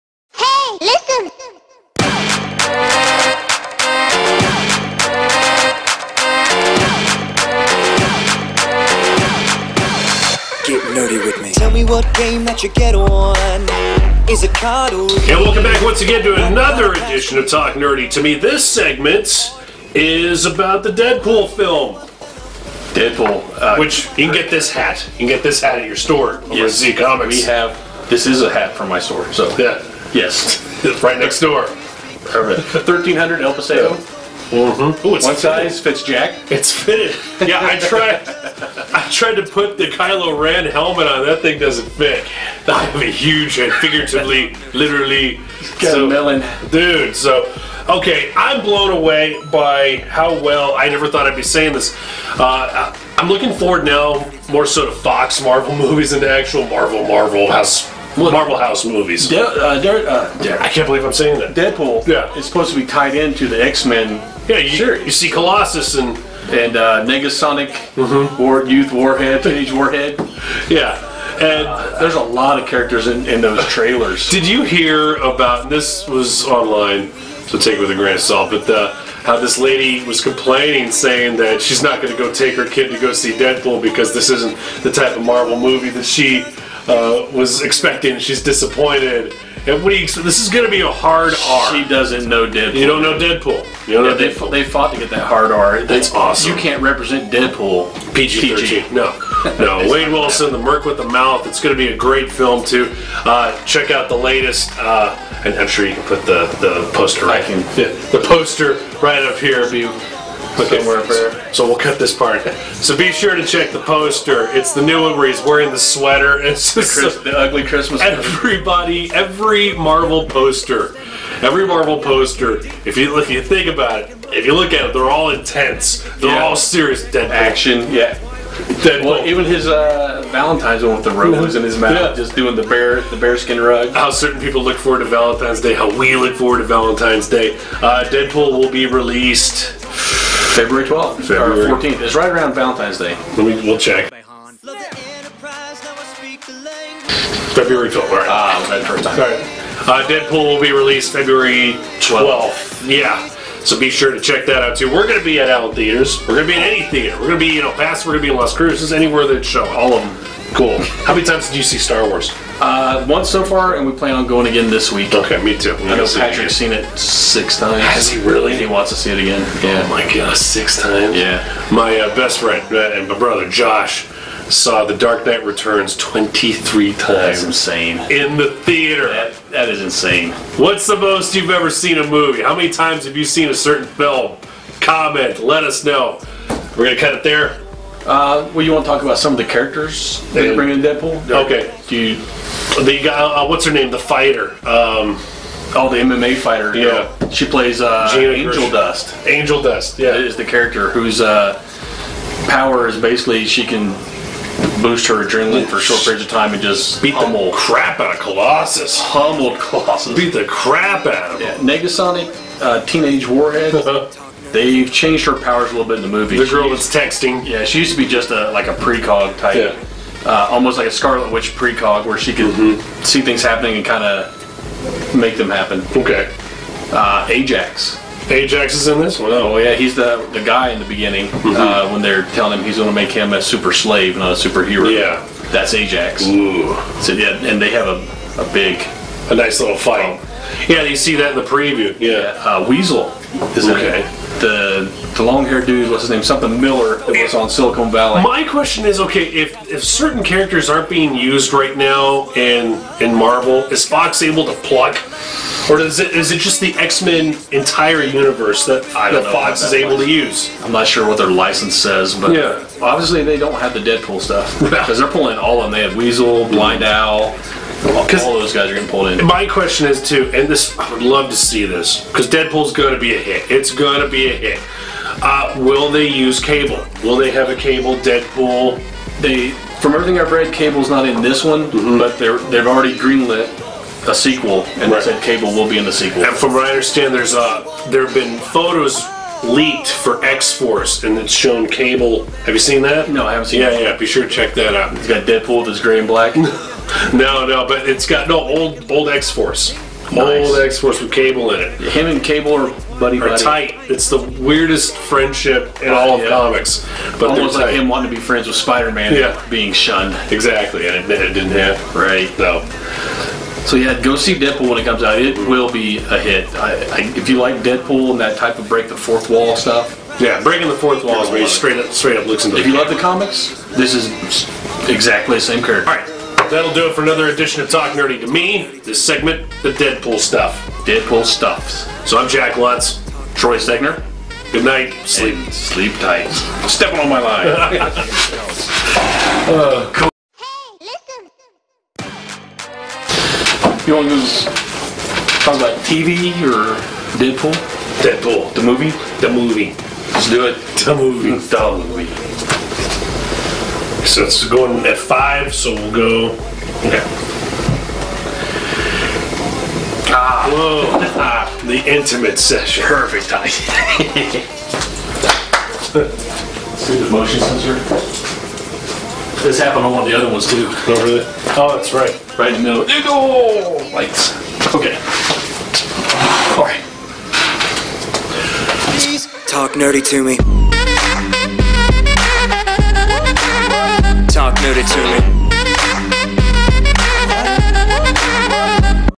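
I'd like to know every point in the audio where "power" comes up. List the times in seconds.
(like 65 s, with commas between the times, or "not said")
202 s, 215 s.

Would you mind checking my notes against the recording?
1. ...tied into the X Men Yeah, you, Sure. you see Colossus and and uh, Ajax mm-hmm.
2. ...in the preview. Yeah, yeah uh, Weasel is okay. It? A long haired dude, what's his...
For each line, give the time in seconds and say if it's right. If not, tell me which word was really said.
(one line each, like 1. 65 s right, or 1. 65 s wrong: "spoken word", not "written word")
1. 62 s wrong: "Negasonic", not "Ajax"
2. 241 s right.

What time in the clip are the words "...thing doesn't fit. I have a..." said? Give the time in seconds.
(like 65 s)
41 s.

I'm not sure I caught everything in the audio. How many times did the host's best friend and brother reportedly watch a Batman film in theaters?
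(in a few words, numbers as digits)
23.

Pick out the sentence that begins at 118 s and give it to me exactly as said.
Everybody, every Marvel poster, every Marvel poster.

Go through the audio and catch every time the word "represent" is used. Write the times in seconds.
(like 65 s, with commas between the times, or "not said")
96 s.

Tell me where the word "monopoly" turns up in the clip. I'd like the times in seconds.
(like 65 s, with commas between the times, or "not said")
not said.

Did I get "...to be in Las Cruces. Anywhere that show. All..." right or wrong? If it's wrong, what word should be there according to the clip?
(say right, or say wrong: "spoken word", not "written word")
right.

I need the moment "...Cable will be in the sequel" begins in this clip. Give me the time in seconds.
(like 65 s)
285 s.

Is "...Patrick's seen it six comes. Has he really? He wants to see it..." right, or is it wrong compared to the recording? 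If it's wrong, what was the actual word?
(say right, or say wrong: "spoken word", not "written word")
wrong: "times", not "comes".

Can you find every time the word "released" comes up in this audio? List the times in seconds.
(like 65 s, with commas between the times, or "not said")
138 s, 150 s.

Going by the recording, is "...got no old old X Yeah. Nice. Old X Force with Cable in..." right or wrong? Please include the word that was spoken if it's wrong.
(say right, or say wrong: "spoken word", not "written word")
wrong: "Force", not "Yeah".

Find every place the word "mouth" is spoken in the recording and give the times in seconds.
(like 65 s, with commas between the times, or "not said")
101 s, 131 s.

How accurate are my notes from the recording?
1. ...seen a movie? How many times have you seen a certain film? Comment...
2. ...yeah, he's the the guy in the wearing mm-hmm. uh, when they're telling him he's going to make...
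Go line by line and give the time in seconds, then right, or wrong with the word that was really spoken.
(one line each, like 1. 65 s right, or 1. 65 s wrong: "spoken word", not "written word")
1. 181 s right
2. 229 s wrong: "beginning", not "wearing".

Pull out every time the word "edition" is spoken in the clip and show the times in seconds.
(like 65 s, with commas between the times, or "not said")
16 s, 327 s.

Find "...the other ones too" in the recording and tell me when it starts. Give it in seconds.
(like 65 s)
370 s.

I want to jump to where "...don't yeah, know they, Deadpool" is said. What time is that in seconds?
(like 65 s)
93 s.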